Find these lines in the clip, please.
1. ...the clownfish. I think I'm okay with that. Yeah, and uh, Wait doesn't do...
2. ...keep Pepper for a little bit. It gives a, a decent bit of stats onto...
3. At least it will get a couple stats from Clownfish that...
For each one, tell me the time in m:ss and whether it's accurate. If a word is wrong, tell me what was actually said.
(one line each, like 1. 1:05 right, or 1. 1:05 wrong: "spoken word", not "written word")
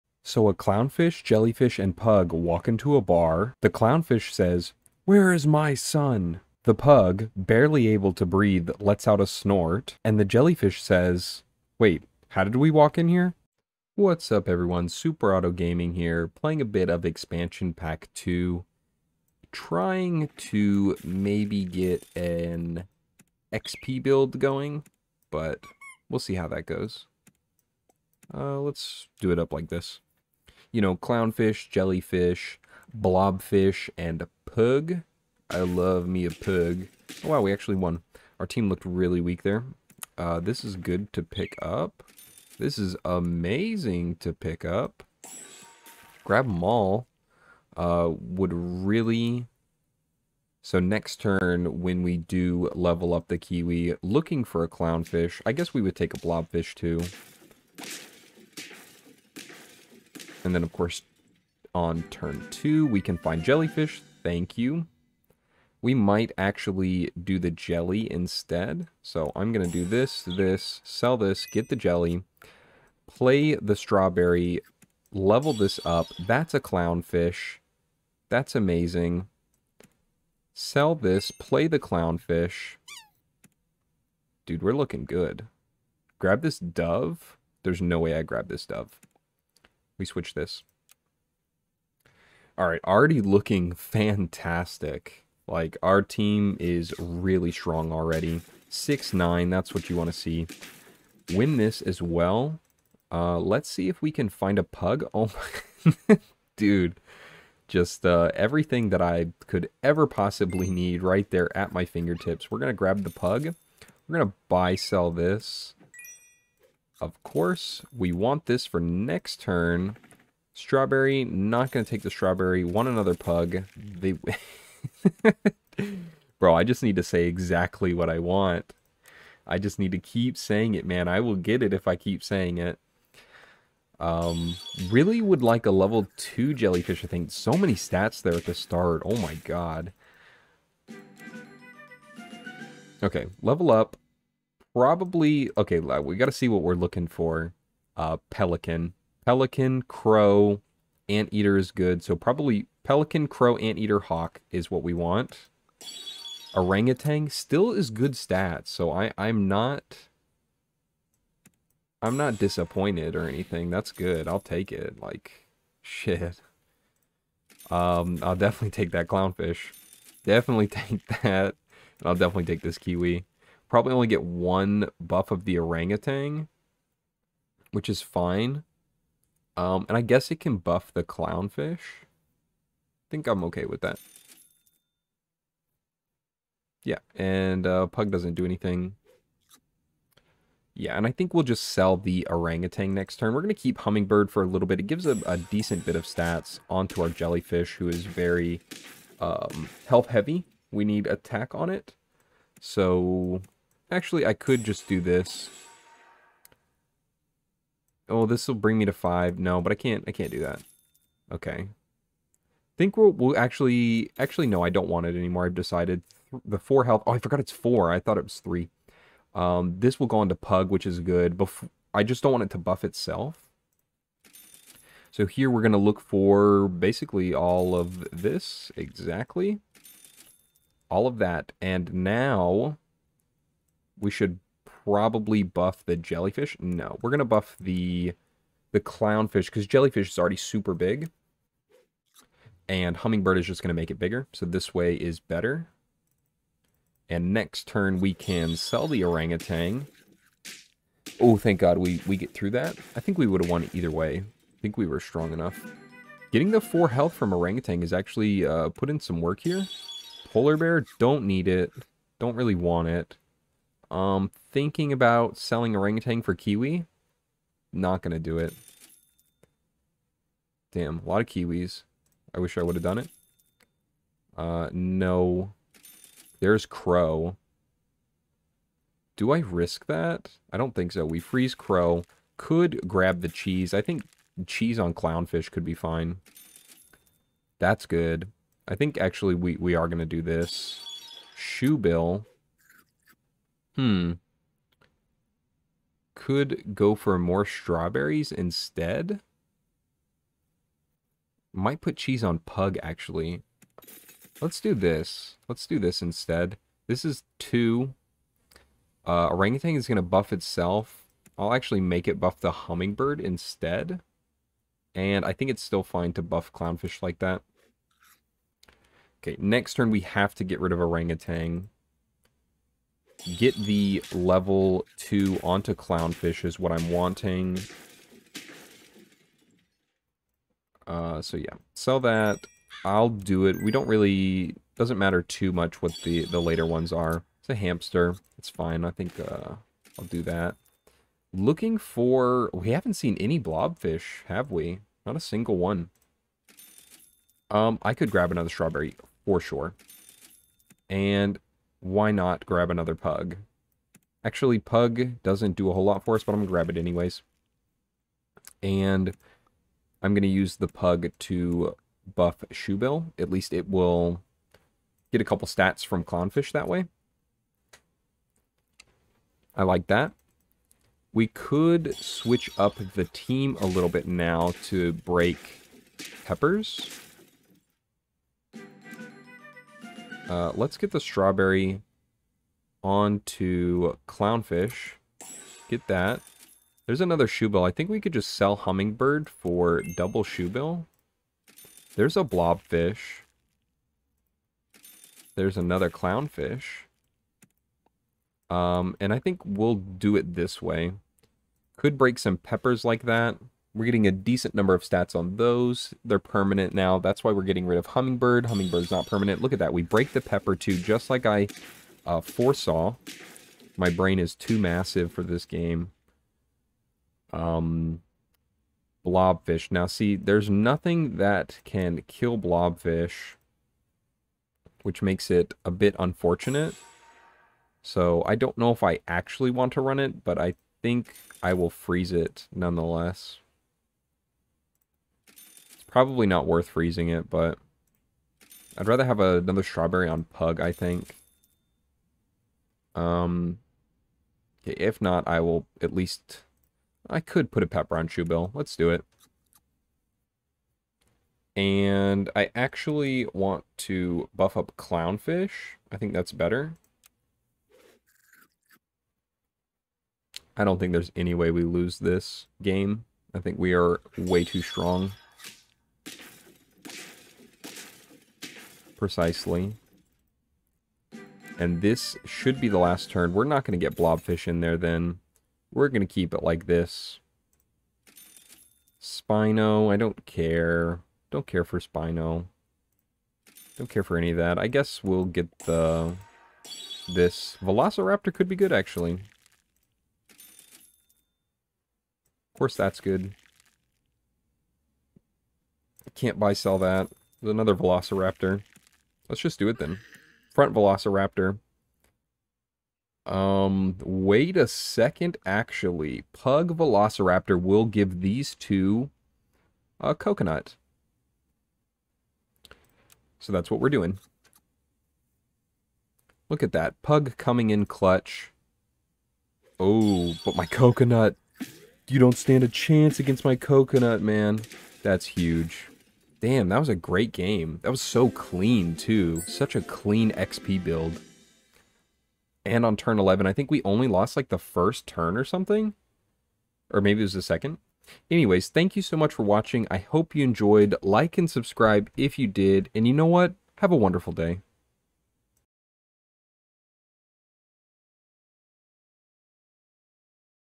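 1. 3:00 wrong: "Pug", not "Wait"
2. 3:13 wrong: "Hummingbird", not "Pepper"
3. 6:03 right.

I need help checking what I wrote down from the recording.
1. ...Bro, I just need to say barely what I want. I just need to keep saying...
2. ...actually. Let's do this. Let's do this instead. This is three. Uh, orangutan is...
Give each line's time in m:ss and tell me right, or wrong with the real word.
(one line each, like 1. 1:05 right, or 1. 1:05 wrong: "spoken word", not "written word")
1. 2:06 wrong: "exactly", not "barely"
2. 5:02 wrong: "two", not "three".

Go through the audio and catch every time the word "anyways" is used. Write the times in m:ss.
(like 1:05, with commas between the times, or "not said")
5:56, 8:58.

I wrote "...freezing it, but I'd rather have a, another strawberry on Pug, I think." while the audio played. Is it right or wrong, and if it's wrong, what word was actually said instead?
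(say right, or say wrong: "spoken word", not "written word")
right.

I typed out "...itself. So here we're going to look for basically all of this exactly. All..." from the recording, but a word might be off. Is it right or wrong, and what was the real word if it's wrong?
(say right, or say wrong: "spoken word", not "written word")
right.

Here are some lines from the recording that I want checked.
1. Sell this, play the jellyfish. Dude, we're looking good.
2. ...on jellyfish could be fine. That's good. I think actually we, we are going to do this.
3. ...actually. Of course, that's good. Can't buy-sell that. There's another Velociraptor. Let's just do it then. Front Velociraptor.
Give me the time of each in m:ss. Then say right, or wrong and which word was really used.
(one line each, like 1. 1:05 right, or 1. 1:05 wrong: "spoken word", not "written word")
1. 1:20 wrong: "clownfish", not "jellyfish"
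2. 4:44 wrong: "clownfish", not "jellyfish"
3. 8:08 right.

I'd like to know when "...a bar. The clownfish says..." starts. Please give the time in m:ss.
0:02.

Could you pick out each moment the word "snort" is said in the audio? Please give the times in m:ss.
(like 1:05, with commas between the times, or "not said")
0:09.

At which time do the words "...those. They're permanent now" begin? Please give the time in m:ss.
6:45.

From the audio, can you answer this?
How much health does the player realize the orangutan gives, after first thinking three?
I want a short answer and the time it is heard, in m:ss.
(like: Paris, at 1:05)
4, at 3:37.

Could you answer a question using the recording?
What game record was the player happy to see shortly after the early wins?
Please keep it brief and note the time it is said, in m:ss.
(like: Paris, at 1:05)
6-9, at 1:38.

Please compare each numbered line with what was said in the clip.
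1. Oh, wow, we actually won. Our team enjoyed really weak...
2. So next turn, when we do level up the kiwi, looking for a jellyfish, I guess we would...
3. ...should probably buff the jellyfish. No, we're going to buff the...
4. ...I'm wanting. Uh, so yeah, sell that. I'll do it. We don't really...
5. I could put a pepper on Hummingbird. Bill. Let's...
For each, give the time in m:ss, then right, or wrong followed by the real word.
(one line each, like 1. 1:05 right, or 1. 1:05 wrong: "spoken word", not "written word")
1. 0:37 wrong: "looked", not "enjoyed"
2. 0:50 wrong: "clownfish", not "jellyfish"
3. 3:54 right
4. 5:26 right
5. 7:27 wrong: "Shoebill", not "Hummingbird".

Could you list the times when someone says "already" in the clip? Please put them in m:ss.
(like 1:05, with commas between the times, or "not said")
1:32, 1:37, 4:00.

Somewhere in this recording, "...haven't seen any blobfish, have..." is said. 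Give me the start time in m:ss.
5:42.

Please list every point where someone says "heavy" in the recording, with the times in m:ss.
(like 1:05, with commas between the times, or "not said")
3:20.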